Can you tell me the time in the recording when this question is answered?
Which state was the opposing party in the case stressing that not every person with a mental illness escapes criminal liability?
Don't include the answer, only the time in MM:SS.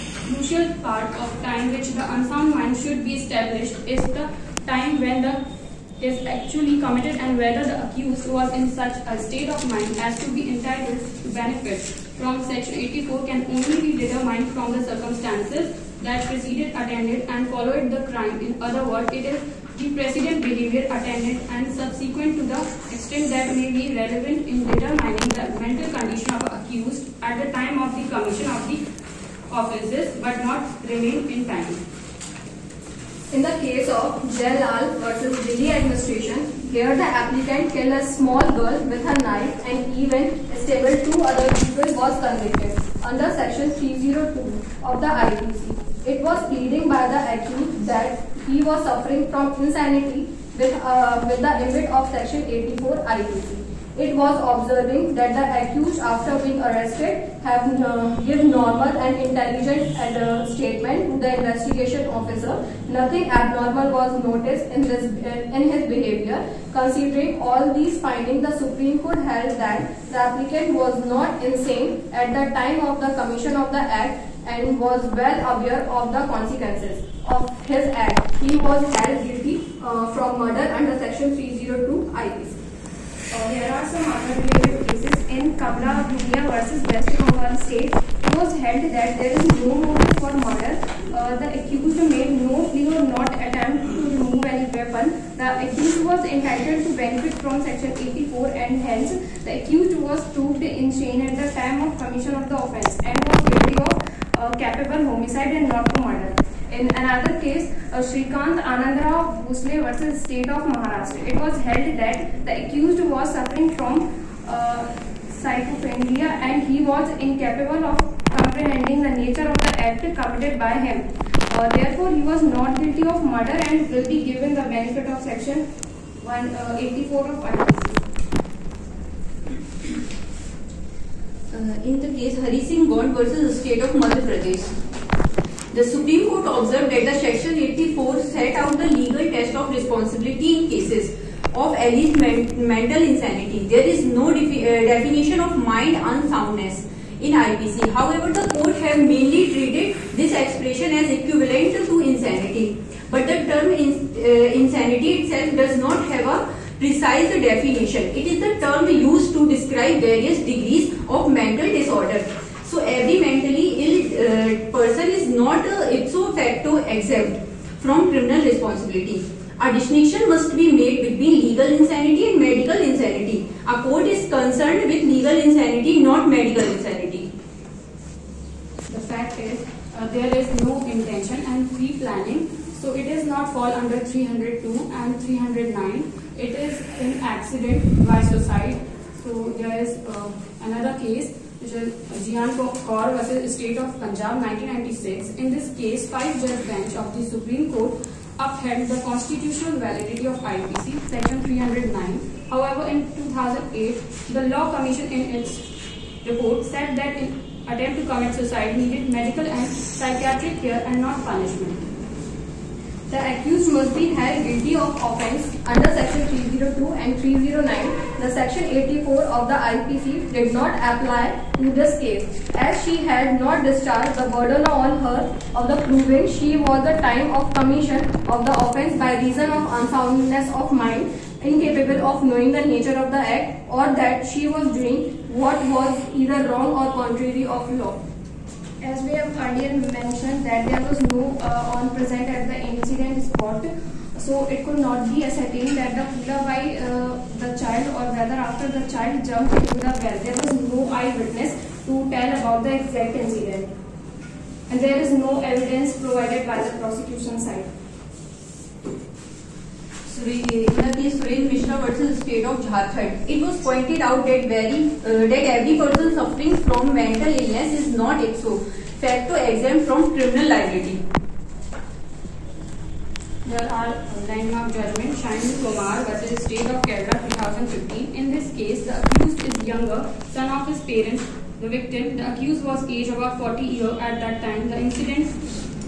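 04:22.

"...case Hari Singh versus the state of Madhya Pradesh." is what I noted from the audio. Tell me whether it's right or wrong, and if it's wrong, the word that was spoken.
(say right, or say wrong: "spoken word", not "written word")
right.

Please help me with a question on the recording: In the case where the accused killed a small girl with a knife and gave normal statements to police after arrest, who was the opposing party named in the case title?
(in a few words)
Delhi administration.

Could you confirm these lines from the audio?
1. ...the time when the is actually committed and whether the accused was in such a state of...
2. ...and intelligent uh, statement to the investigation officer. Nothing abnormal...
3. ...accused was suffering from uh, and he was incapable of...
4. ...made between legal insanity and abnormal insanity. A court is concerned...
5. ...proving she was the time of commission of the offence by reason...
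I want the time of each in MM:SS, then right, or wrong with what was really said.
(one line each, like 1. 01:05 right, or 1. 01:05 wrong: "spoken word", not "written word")
1. 00:04 right
2. 00:58 right
3. 01:52 right
4. 02:50 wrong: "medical", not "abnormal"
5. 03:45 right.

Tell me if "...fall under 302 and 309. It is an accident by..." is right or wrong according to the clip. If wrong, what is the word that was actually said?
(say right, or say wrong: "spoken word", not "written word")
right.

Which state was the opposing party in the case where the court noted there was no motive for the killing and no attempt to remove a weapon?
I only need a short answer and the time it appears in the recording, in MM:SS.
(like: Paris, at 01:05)
West Bengal, at 01:26.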